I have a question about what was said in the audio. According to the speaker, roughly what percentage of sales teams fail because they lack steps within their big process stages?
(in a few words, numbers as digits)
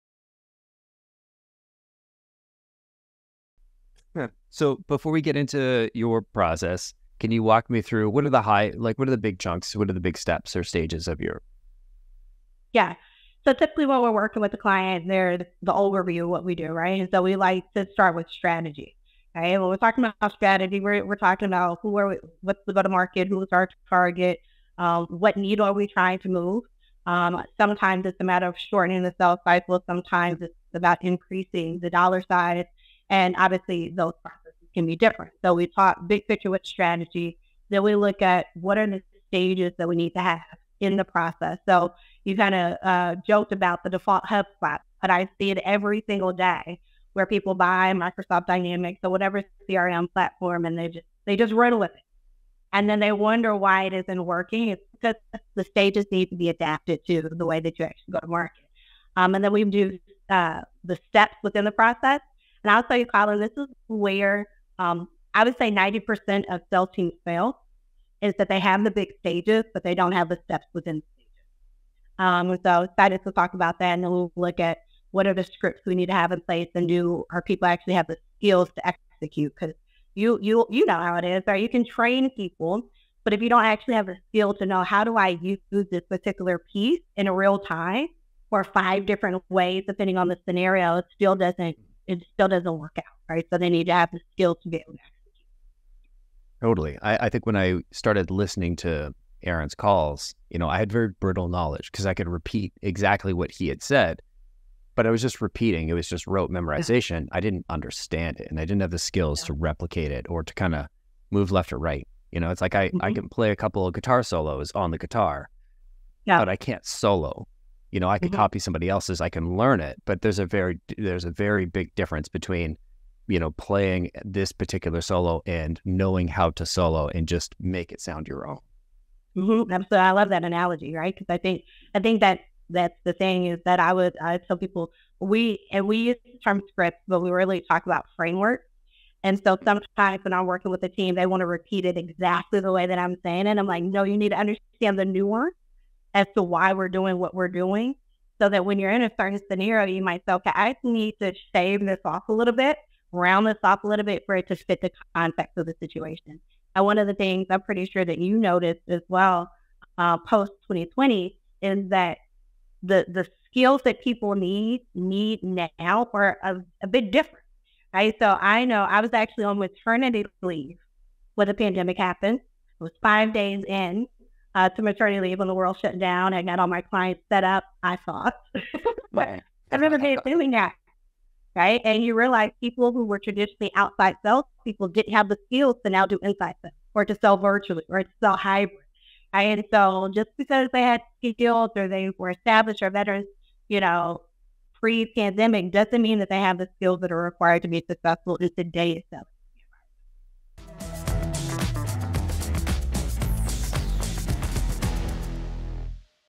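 90%.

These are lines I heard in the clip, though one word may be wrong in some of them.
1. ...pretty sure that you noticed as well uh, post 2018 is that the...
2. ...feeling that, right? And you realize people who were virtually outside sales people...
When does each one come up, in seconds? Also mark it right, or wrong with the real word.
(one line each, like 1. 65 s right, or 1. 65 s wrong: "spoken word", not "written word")
1. 157 s wrong: "2020", not "2018"
2. 180 s wrong: "traditionally", not "virtually".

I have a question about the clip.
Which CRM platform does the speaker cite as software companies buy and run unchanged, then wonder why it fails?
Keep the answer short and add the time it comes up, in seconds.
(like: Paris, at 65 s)
Microsoft Dynamics, at 47 s.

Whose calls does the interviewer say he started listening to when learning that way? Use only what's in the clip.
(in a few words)
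Aaron.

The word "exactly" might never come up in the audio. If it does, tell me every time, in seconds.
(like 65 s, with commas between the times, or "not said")
102 s, 141 s.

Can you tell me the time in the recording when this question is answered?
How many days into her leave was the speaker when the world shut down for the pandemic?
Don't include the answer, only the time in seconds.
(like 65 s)
173 s.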